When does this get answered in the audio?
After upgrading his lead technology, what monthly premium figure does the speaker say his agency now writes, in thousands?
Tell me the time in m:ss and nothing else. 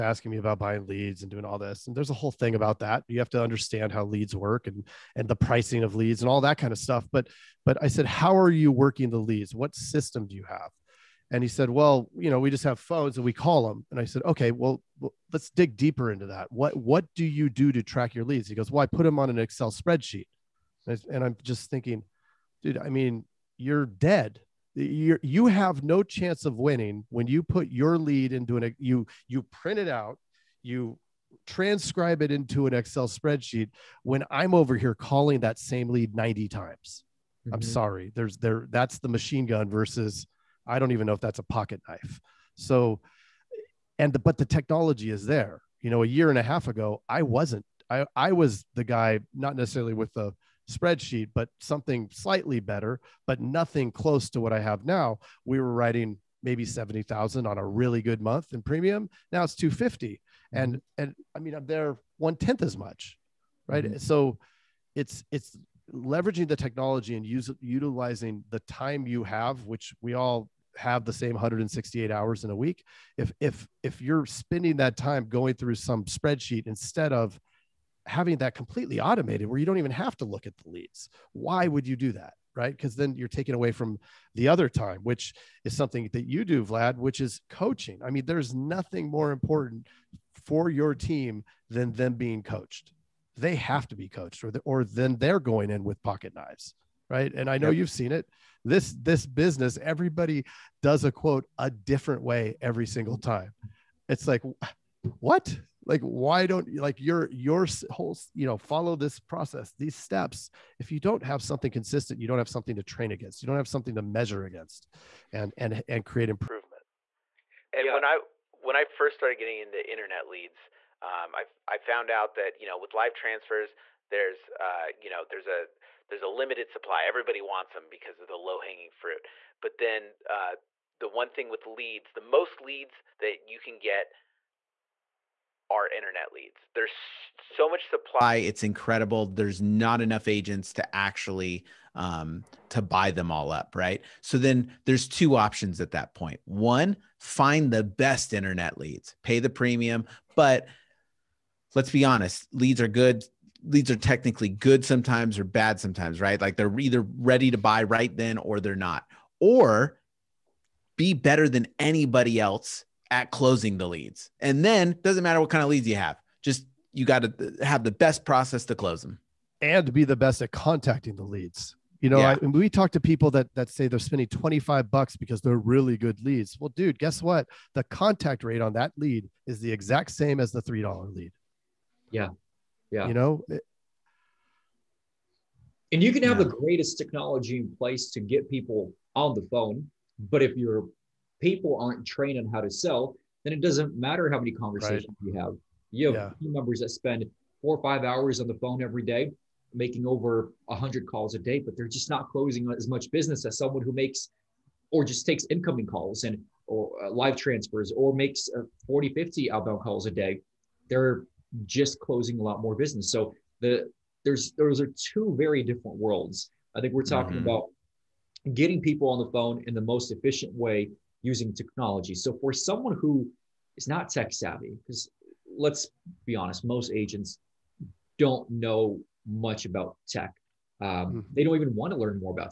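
0:59.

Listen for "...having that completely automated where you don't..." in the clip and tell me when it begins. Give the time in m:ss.
1:18.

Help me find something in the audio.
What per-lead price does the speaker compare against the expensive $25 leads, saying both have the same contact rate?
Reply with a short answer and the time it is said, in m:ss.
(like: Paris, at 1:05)
$3, at 3:00.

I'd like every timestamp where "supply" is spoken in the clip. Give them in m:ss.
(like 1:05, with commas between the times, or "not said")
2:06, 2:17.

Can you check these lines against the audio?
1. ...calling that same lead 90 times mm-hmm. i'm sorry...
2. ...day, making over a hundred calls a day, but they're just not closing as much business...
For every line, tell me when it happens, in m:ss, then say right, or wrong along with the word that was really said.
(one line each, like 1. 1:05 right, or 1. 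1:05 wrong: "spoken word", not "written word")
1. 0:34 right
2. 3:19 right.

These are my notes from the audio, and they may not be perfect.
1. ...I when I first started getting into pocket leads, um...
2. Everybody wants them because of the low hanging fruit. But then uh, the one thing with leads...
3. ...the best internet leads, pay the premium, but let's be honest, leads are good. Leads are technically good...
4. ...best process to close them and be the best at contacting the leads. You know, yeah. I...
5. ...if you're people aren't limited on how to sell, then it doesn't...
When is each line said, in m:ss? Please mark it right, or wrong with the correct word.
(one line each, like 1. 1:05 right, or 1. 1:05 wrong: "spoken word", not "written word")
1. 1:58 wrong: "internet", not "pocket"
2. 2:07 right
3. 2:27 right
4. 2:47 right
5. 3:10 wrong: "trained", not "limited".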